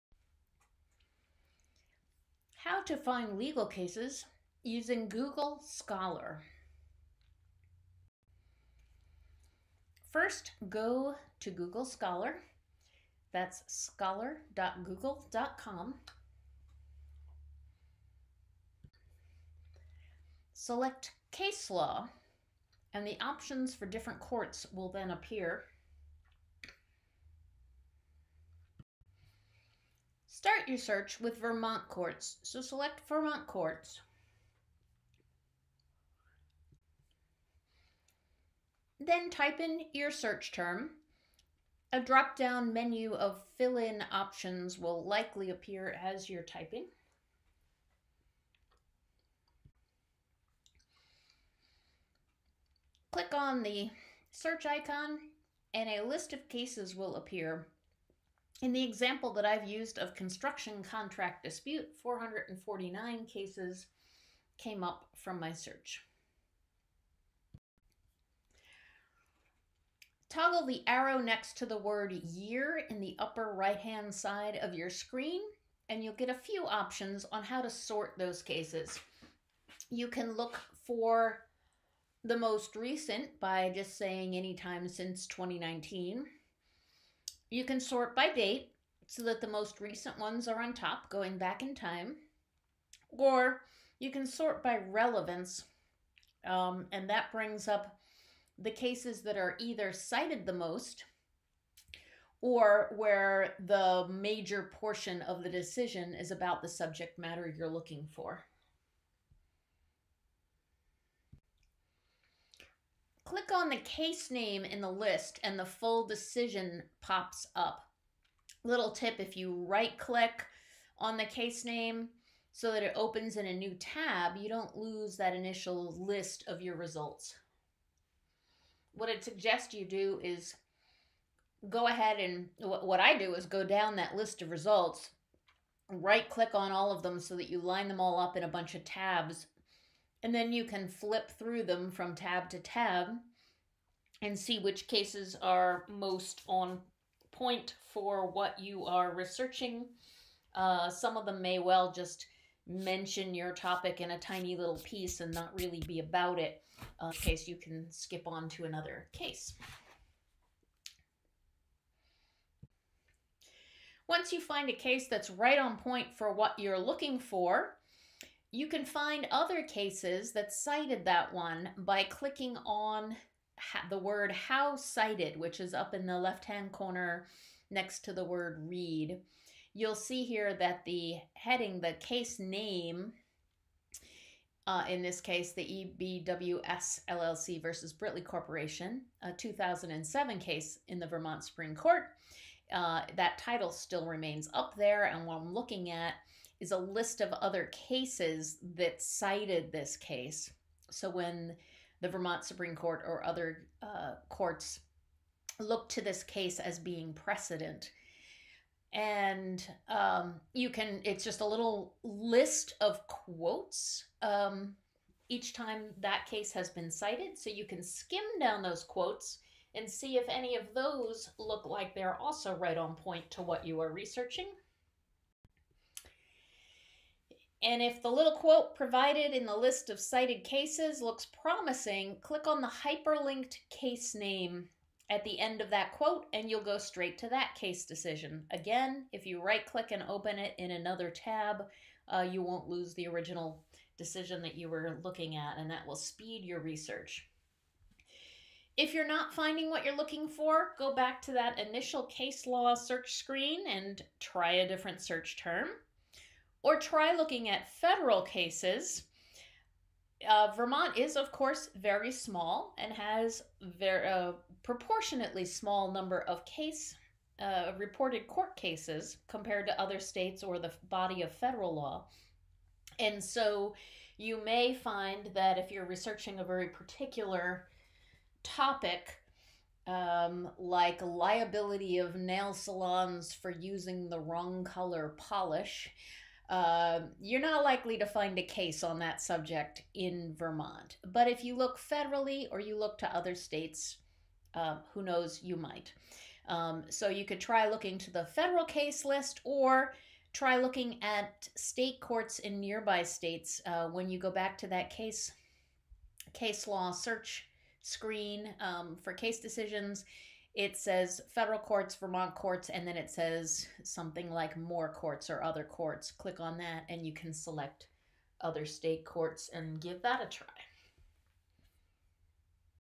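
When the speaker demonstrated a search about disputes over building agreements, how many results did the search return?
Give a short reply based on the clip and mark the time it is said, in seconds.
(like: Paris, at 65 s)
449, at 62 s.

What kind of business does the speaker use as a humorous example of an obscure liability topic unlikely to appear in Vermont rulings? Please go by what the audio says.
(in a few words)
Nail salons.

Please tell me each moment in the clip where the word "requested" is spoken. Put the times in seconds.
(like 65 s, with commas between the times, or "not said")
not said.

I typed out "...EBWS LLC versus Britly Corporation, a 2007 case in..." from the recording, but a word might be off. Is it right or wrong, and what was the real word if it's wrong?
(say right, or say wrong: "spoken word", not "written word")
right.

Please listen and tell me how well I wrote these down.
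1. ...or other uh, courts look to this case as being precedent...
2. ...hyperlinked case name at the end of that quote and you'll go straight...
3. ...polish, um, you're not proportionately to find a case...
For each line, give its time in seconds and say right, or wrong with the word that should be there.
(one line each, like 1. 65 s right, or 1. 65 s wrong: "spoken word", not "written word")
1. 203 s right
2. 232 s right
3. 285 s wrong: "likely", not "proportionately".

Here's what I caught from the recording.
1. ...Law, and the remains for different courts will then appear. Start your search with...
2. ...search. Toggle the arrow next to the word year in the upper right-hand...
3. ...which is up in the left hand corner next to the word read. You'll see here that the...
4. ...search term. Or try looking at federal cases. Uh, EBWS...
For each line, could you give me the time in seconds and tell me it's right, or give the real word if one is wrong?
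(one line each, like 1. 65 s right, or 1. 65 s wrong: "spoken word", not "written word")
1. 21 s wrong: "options", not "remains"
2. 65 s right
3. 175 s right
4. 255 s wrong: "Vermont", not "EBWS".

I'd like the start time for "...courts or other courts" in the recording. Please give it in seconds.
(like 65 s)
314 s.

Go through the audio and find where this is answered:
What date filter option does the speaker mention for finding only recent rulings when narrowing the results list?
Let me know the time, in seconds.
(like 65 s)
84 s.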